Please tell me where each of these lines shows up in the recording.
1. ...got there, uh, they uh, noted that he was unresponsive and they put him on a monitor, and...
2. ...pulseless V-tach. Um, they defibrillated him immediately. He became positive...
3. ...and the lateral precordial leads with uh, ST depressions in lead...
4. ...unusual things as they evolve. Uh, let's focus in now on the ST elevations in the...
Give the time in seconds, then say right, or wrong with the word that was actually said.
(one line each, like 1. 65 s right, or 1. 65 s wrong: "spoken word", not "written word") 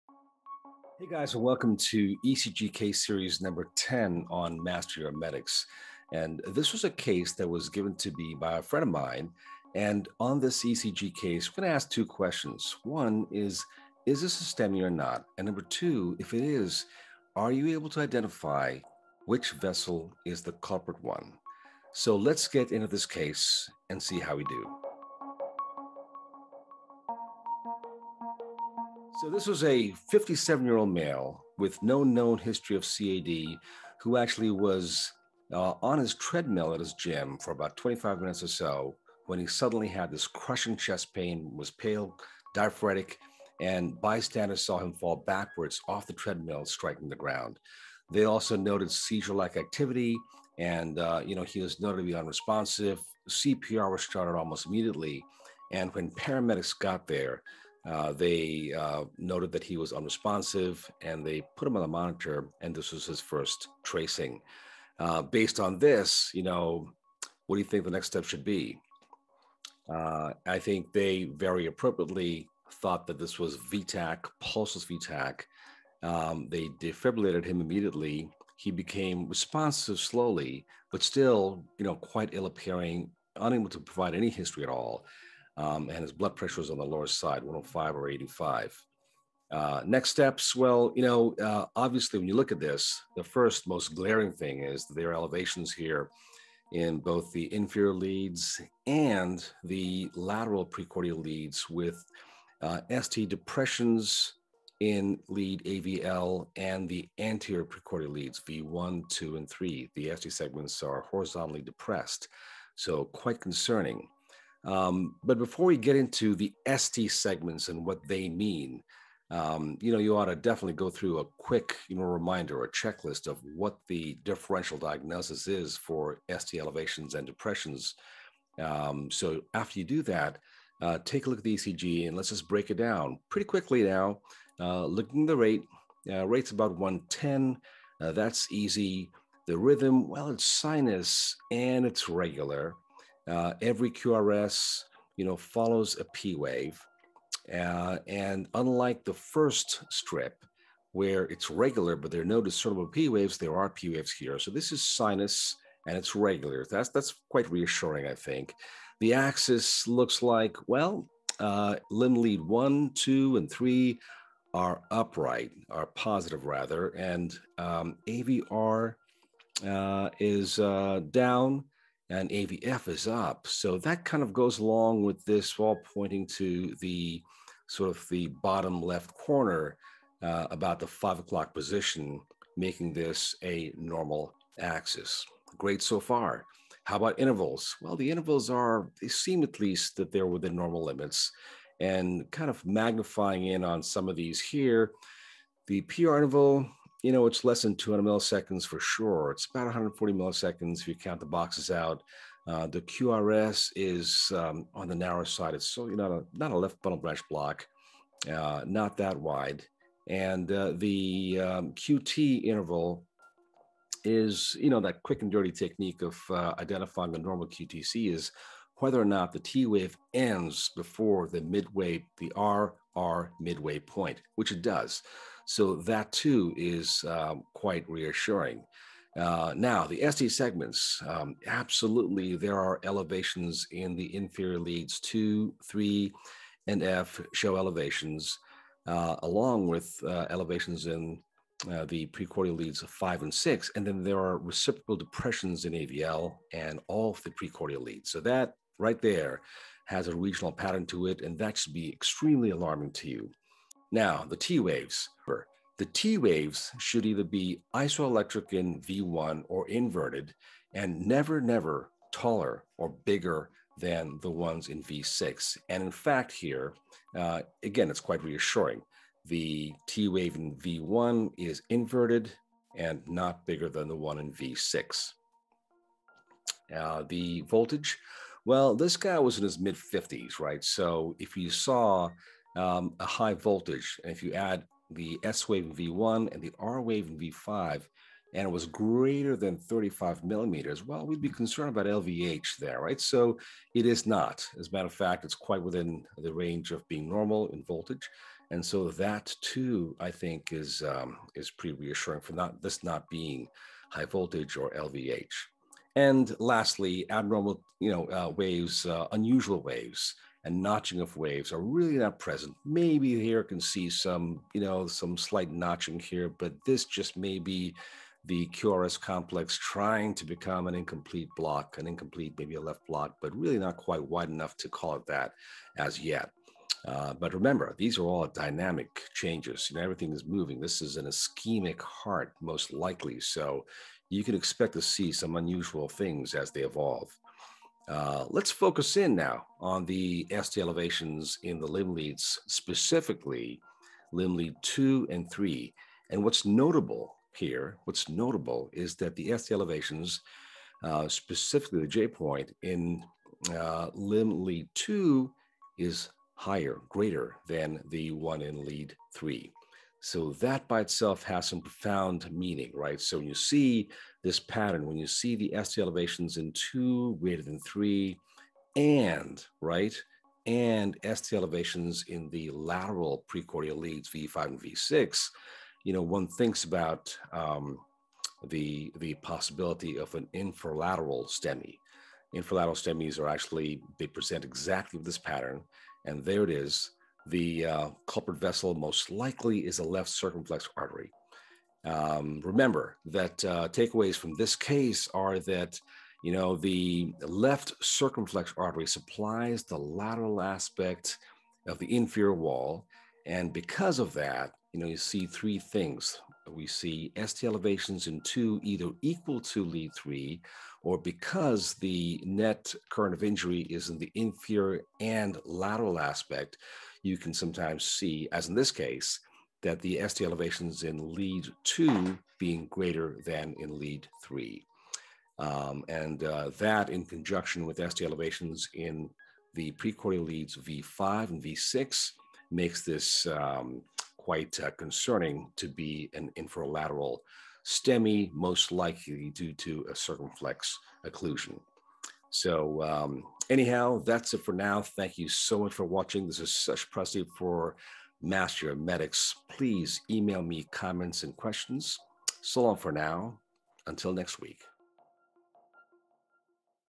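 1. 56 s right
2. 74 s wrong: "responsive", not "positive"
3. 98 s right
4. 335 s right.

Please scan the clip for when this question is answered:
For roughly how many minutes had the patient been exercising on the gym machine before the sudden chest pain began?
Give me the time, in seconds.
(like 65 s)
37 s.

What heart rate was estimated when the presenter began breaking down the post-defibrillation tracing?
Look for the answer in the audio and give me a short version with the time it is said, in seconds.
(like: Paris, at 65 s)
About 110, at 136 s.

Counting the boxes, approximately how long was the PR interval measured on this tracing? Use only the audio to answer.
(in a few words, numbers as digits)
140 milliseconds.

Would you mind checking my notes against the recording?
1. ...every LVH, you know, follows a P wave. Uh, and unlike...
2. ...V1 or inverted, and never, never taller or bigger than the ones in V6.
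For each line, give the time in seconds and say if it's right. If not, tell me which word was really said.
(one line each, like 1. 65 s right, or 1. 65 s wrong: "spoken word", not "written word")
1. 143 s wrong: "QRS", not "LVH"
2. 258 s right.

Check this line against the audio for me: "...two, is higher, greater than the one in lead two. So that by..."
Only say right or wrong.
wrong.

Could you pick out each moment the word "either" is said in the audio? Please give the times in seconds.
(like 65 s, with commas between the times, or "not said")
257 s, 408 s.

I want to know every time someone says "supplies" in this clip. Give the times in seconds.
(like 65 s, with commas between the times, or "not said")
398 s.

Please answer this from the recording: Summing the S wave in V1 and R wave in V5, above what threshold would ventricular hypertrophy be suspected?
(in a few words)
35 millimeters.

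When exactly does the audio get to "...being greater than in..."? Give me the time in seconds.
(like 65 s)
422 s.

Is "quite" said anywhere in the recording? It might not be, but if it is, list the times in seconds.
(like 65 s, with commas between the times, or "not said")
81 s, 113 s, 157 s, 227 s, 267 s, 295 s, 323 s, 434 s.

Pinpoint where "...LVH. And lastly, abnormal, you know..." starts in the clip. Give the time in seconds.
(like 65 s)
304 s.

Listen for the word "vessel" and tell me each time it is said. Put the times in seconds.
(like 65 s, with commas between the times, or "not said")
19 s, 388 s.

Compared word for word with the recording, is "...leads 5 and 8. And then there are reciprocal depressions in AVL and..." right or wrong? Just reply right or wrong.
wrong.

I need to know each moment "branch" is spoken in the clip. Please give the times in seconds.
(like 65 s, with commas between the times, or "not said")
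206 s.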